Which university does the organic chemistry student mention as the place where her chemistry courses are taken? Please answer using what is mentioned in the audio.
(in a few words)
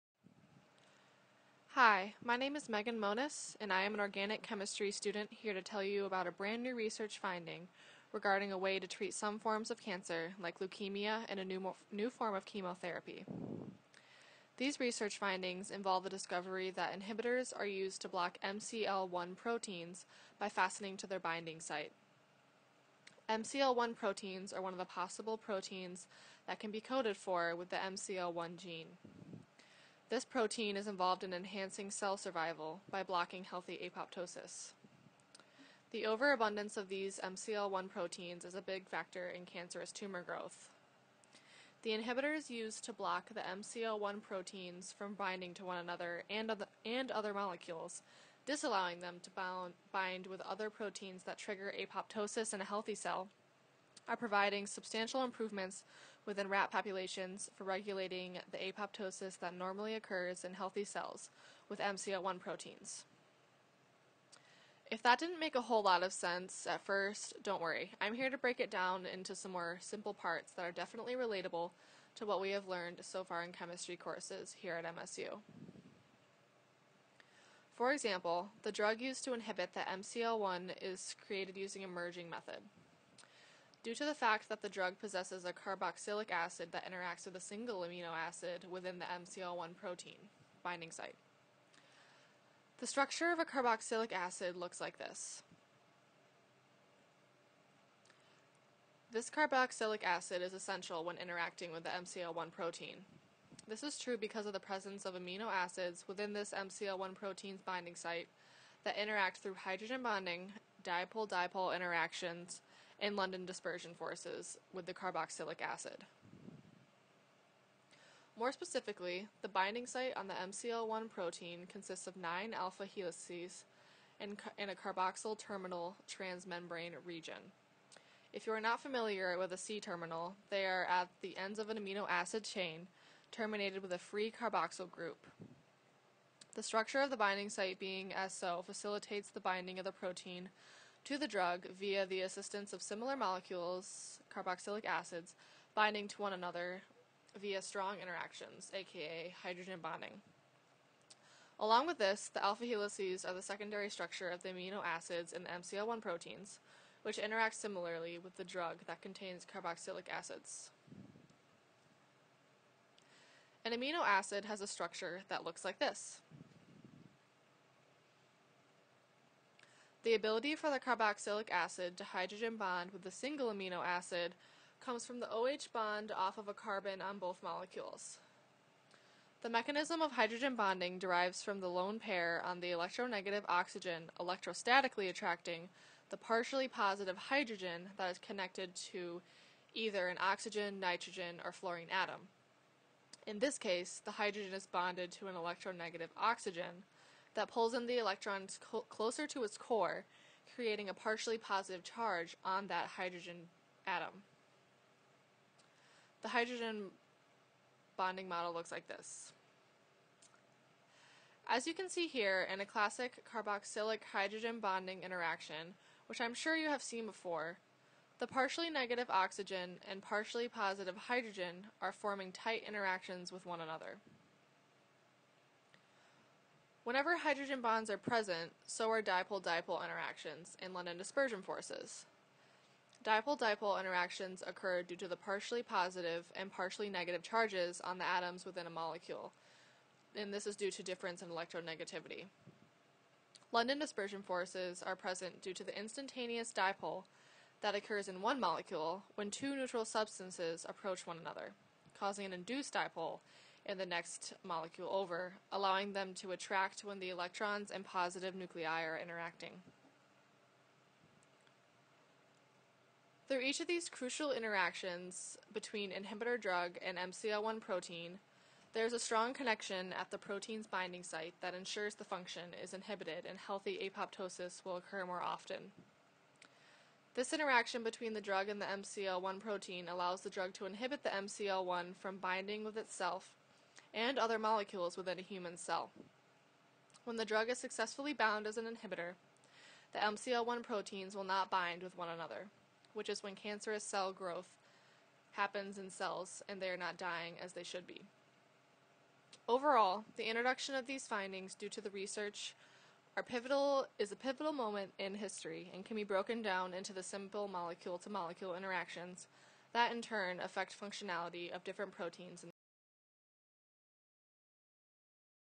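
MSU.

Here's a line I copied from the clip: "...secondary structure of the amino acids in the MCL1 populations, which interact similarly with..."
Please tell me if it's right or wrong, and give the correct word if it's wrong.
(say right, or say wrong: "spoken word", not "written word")
wrong: "proteins", not "populations".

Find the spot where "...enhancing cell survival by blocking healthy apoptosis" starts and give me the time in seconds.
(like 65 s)
31 s.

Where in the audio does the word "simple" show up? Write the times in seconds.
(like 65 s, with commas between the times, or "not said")
69 s, 307 s.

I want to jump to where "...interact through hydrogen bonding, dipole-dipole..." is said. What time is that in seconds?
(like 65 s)
108 s.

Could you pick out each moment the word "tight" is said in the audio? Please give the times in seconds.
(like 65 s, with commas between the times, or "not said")
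222 s.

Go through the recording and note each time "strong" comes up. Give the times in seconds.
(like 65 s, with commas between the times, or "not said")
147 s, 268 s.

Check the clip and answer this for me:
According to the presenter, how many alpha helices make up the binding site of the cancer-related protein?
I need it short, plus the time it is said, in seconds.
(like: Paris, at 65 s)
9, at 122 s.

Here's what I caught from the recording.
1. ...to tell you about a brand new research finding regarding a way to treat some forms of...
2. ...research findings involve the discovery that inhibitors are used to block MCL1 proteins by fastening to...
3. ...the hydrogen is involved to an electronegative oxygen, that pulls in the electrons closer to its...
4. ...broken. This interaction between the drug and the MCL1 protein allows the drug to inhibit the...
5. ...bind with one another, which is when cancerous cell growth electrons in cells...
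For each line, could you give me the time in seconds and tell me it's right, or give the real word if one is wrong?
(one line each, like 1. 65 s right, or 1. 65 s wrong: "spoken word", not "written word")
1. 5 s right
2. 14 s right
3. 194 s wrong: "bonded", not "involved"
4. 275 s wrong: "often", not "broken"
5. 291 s wrong: "happens", not "electrons".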